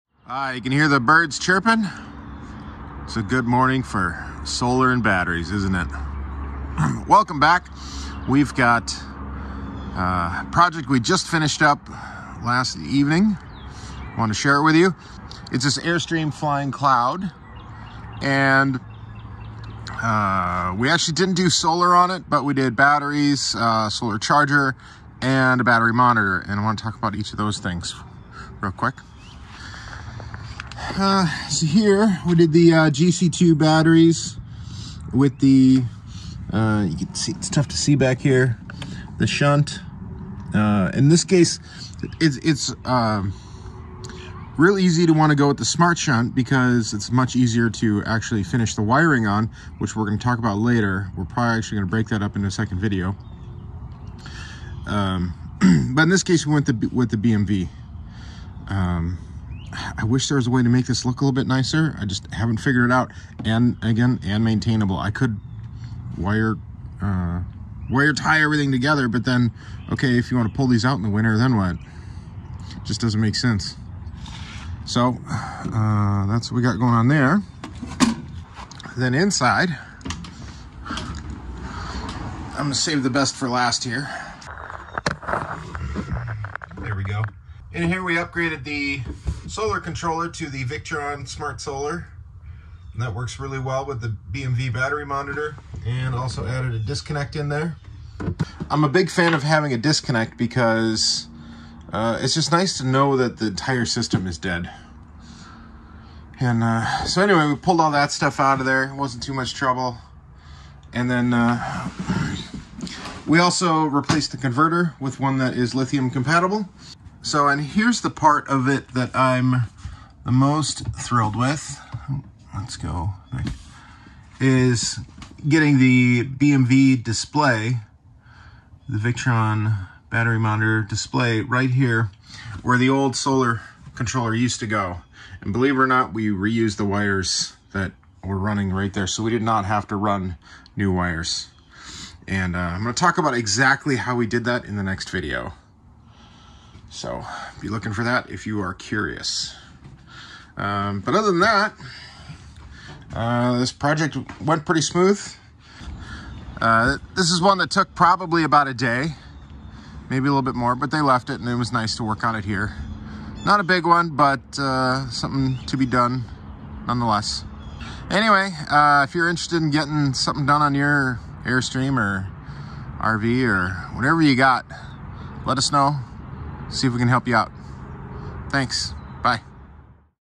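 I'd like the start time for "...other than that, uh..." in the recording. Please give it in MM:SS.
02:31.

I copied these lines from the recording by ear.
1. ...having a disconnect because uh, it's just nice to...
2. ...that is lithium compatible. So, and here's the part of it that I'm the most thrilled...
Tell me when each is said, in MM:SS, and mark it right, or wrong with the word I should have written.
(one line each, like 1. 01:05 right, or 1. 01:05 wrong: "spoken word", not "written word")
1. 01:39 right
2. 01:55 right.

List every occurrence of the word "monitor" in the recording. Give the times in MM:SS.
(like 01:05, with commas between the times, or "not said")
00:25, 01:35, 02:10.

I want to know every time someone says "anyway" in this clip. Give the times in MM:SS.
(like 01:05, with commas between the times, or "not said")
01:47, 02:48.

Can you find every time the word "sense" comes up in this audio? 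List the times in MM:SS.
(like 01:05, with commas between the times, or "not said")
01:13.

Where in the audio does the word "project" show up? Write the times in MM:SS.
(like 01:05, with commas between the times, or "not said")
00:10, 02:33.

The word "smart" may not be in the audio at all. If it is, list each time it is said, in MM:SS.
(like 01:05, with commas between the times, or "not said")
00:45, 01:31.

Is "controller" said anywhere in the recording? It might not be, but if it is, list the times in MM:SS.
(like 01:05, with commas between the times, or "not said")
01:29, 02:13.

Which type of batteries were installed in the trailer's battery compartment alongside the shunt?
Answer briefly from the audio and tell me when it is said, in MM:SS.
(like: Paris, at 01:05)
GC2, at 00:32.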